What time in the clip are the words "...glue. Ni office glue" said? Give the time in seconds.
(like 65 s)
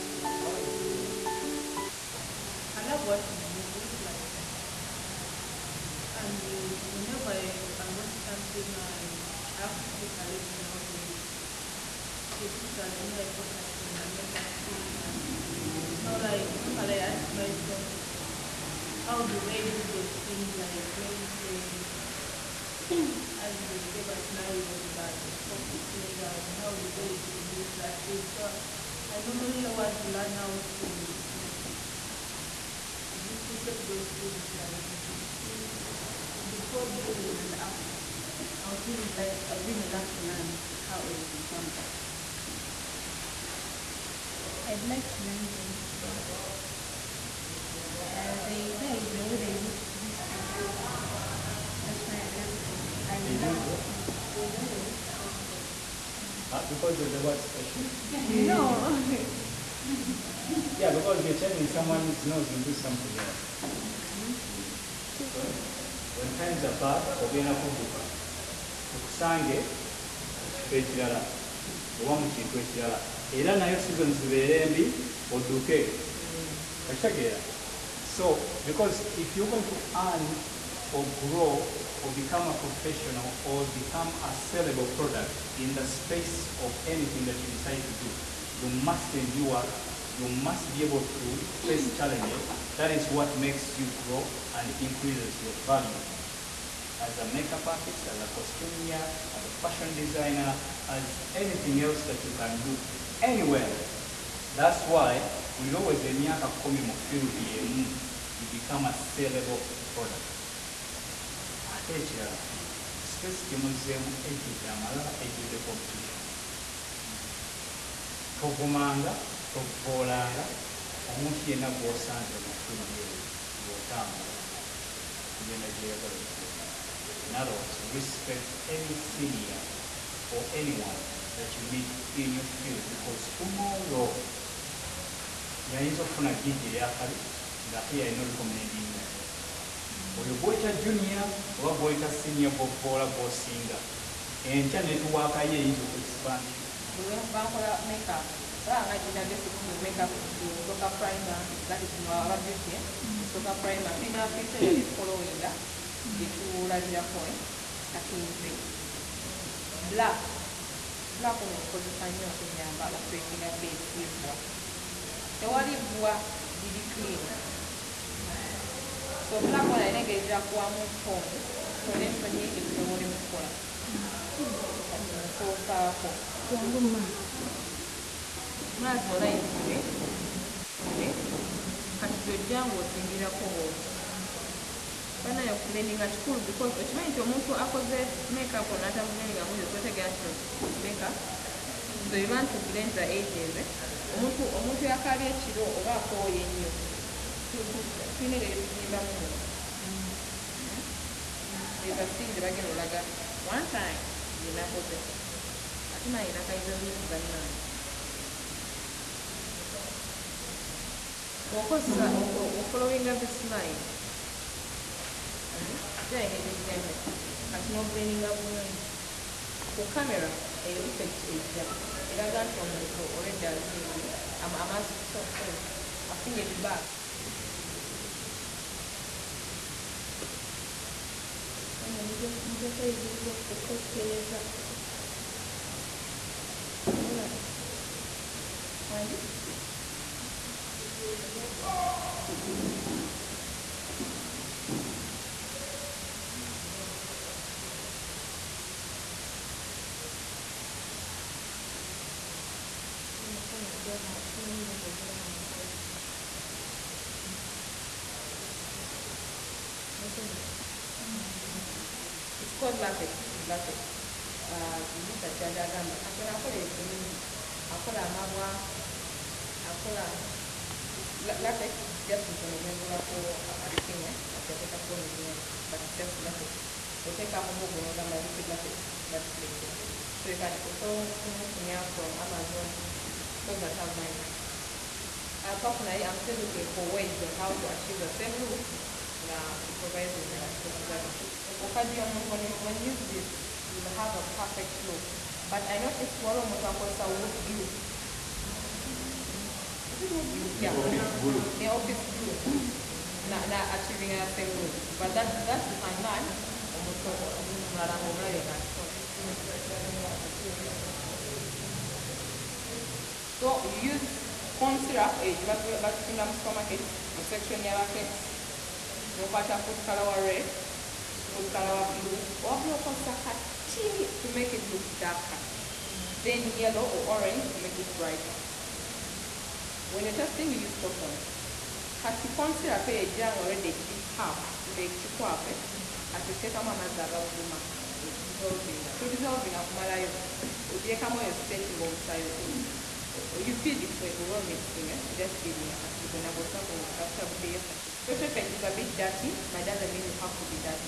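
301 s.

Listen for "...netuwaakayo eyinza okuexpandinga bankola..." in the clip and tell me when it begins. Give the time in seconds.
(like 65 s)
144 s.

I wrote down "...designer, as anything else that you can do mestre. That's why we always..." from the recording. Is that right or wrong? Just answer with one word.
wrong.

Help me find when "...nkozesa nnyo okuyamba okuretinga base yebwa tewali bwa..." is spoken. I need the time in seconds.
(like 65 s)
161 s.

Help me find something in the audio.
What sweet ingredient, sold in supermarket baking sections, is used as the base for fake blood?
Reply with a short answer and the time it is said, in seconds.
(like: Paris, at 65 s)
corn syrup, at 314 s.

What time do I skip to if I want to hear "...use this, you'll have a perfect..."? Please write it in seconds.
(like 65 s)
292 s.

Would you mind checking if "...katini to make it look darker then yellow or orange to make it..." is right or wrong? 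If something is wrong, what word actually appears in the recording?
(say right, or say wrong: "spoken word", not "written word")
right.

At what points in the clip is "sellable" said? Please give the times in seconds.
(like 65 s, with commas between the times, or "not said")
84 s, 108 s.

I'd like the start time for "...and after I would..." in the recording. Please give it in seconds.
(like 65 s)
37 s.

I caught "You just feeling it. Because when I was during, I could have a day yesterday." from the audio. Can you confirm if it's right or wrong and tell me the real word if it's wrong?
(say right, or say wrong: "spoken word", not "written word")
wrong: "talking", not "during".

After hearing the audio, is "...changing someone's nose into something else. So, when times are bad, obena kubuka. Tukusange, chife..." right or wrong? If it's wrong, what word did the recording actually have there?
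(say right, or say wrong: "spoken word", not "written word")
right.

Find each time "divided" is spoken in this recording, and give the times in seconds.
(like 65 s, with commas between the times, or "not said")
not said.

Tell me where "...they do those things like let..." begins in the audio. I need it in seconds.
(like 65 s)
19 s.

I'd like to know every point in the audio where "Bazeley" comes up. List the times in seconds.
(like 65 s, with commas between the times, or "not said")
not said.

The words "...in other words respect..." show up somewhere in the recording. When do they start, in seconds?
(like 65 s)
127 s.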